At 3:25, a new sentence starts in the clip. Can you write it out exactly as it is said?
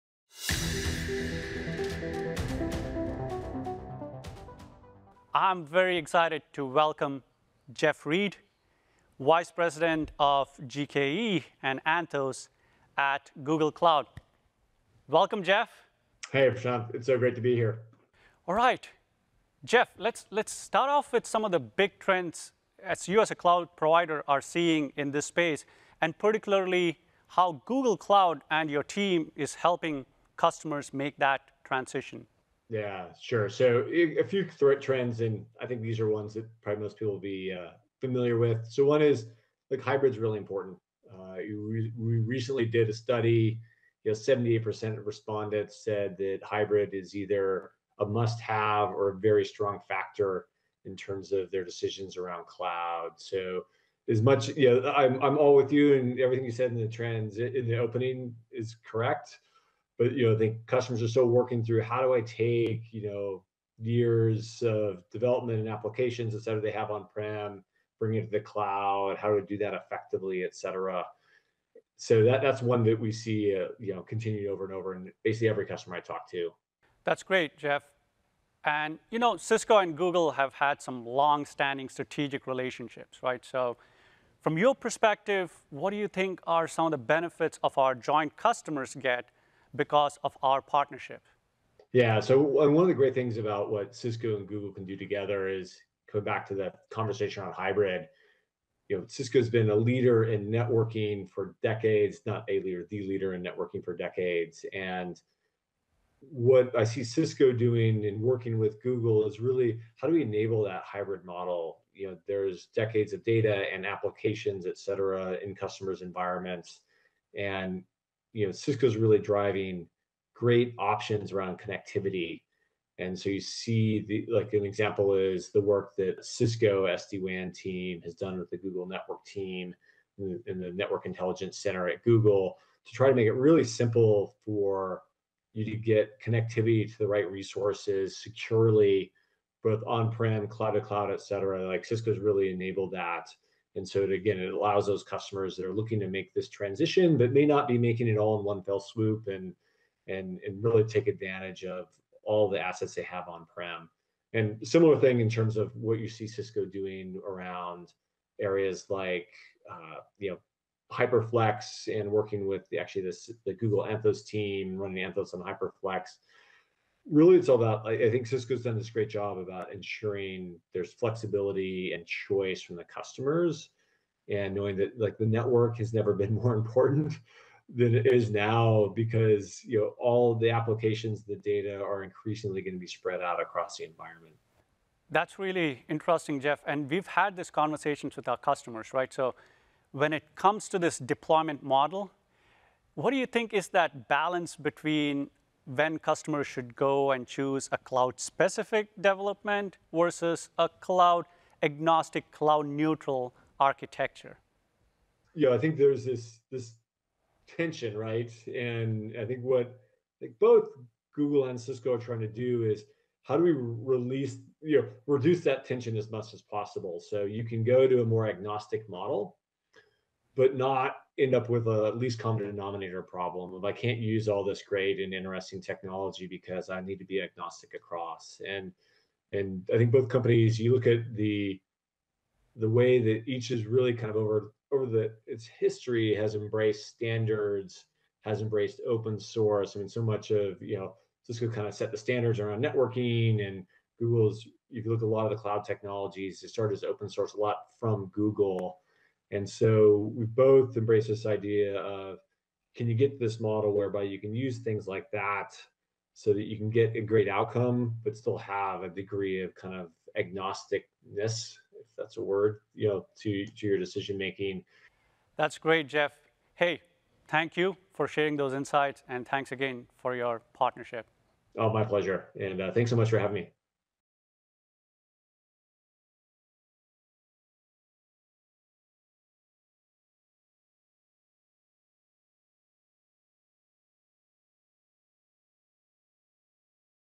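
Yeah, I think there's this this tension, right?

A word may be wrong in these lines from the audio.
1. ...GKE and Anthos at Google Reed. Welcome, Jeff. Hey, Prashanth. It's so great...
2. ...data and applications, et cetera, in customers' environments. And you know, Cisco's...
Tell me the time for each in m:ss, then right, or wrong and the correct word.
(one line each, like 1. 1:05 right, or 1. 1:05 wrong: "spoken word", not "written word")
1. 0:10 wrong: "Cloud", not "Reed"
2. 1:53 right.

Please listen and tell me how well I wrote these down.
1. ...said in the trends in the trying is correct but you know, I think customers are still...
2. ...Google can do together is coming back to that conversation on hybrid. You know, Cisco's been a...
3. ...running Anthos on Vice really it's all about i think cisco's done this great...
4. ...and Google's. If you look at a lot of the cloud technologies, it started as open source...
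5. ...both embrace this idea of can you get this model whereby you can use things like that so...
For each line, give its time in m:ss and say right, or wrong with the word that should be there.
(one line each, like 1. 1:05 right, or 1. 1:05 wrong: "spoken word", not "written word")
1. 0:56 wrong: "opening", not "trying"
2. 1:34 right
3. 2:44 wrong: "Hyperflex", not "Vice"
4. 4:03 right
5. 4:10 right.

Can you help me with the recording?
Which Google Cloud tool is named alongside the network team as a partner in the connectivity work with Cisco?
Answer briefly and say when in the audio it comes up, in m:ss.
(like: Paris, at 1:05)
Network Intelligence Center, at 2:10.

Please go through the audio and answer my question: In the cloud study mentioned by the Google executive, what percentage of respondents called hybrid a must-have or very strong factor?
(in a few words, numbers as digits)
78%.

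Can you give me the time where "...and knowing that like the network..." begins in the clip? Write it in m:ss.
2:54.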